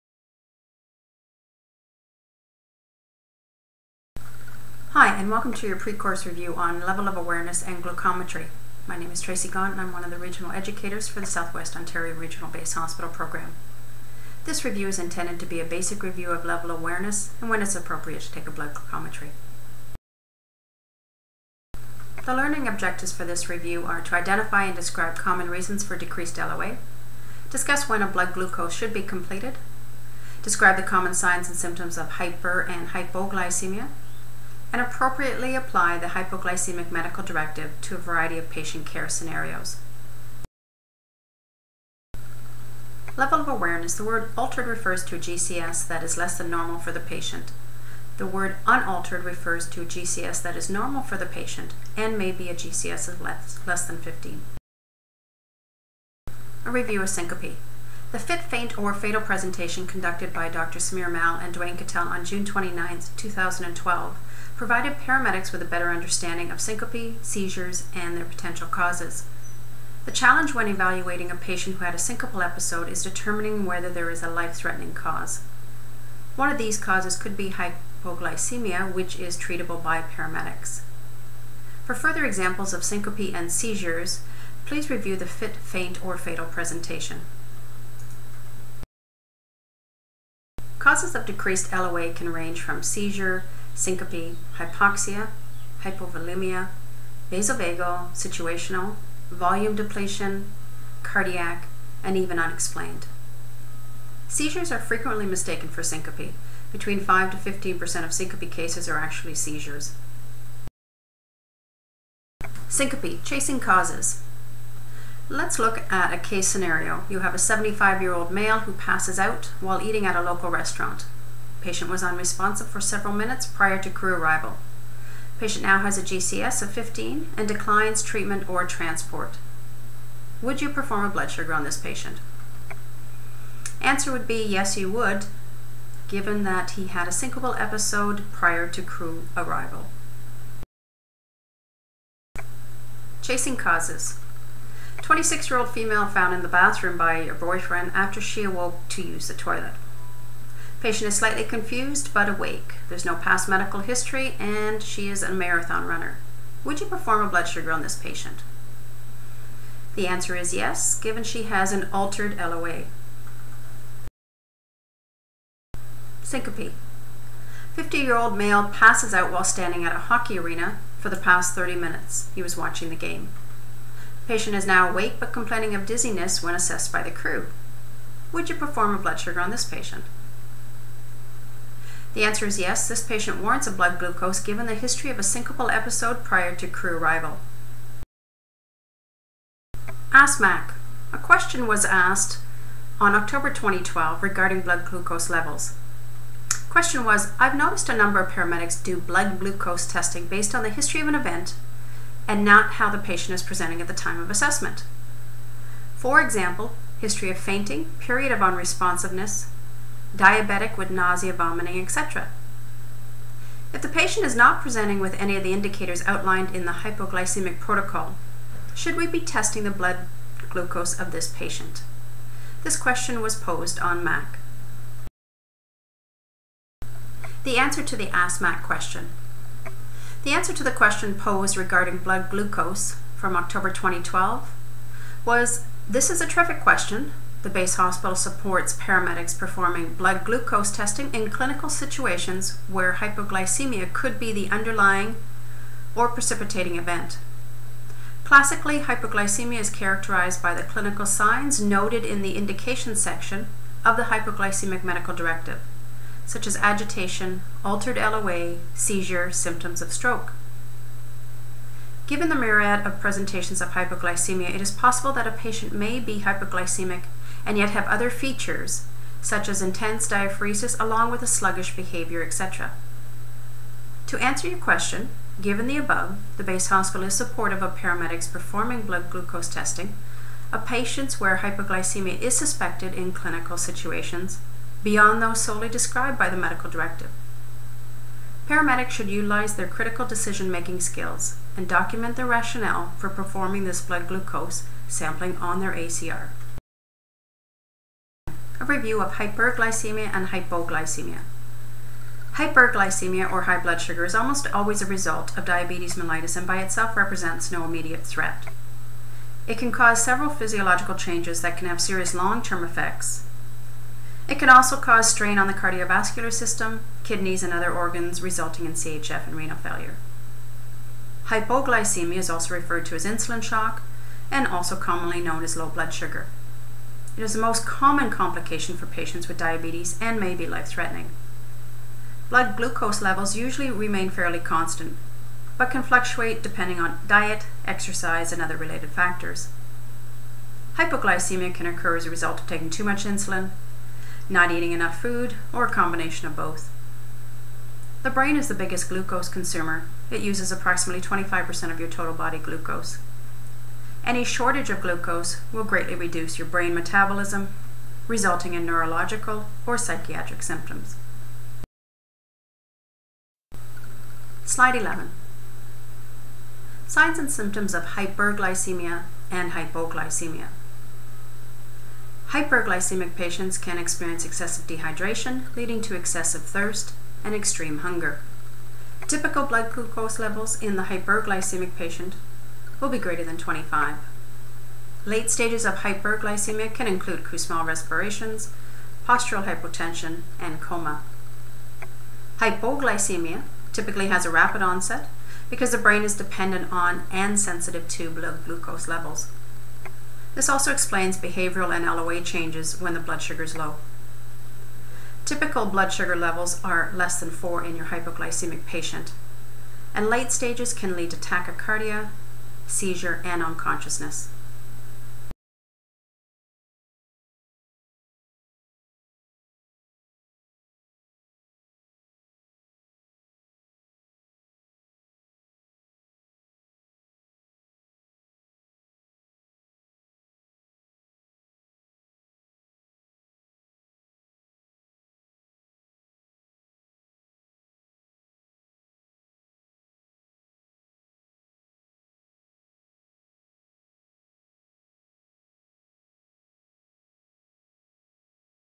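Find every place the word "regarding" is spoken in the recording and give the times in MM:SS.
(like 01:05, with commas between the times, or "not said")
03:14, 03:51.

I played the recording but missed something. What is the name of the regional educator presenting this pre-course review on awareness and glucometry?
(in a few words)
Tracy Gaunt.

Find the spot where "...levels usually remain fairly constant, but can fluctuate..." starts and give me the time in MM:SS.
05:33.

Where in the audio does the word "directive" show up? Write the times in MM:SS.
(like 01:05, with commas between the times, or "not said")
00:37, 04:15, 04:46.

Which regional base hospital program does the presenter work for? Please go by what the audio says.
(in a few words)
Southwest Ontario.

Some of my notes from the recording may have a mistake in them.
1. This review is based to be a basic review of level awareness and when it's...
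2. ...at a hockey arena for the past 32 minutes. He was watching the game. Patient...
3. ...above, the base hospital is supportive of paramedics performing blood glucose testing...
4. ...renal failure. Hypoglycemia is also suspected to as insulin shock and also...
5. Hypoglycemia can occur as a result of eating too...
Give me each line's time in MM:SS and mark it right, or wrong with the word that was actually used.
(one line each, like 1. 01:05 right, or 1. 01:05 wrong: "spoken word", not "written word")
1. 00:14 wrong: "intended", not "based"
2. 02:49 wrong: "30", not "32"
3. 04:35 right
4. 05:19 wrong: "referred", not "suspected"
5. 05:40 wrong: "taking", not "eating".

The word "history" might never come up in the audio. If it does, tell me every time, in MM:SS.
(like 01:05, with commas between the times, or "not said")
02:33, 03:04, 03:20, 03:26.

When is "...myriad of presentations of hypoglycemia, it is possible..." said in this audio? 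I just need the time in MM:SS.
04:22.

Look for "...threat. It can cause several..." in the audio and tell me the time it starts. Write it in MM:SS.
05:08.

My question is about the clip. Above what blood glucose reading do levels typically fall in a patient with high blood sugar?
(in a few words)
25.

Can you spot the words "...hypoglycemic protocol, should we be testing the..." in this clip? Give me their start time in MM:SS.
03:36.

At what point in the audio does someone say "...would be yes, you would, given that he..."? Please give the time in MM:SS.
02:14.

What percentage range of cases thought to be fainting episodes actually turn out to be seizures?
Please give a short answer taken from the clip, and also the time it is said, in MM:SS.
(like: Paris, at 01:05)
5 to 15%, at 01:46.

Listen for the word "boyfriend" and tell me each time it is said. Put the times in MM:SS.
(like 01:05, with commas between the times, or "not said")
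02:27.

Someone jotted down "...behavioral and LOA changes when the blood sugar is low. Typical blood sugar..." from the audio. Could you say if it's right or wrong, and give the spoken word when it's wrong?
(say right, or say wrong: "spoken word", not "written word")
right.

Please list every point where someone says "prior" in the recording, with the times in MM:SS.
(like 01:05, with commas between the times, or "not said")
02:03, 02:18, 03:06.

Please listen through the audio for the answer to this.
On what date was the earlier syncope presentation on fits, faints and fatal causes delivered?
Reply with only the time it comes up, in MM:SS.
01:02.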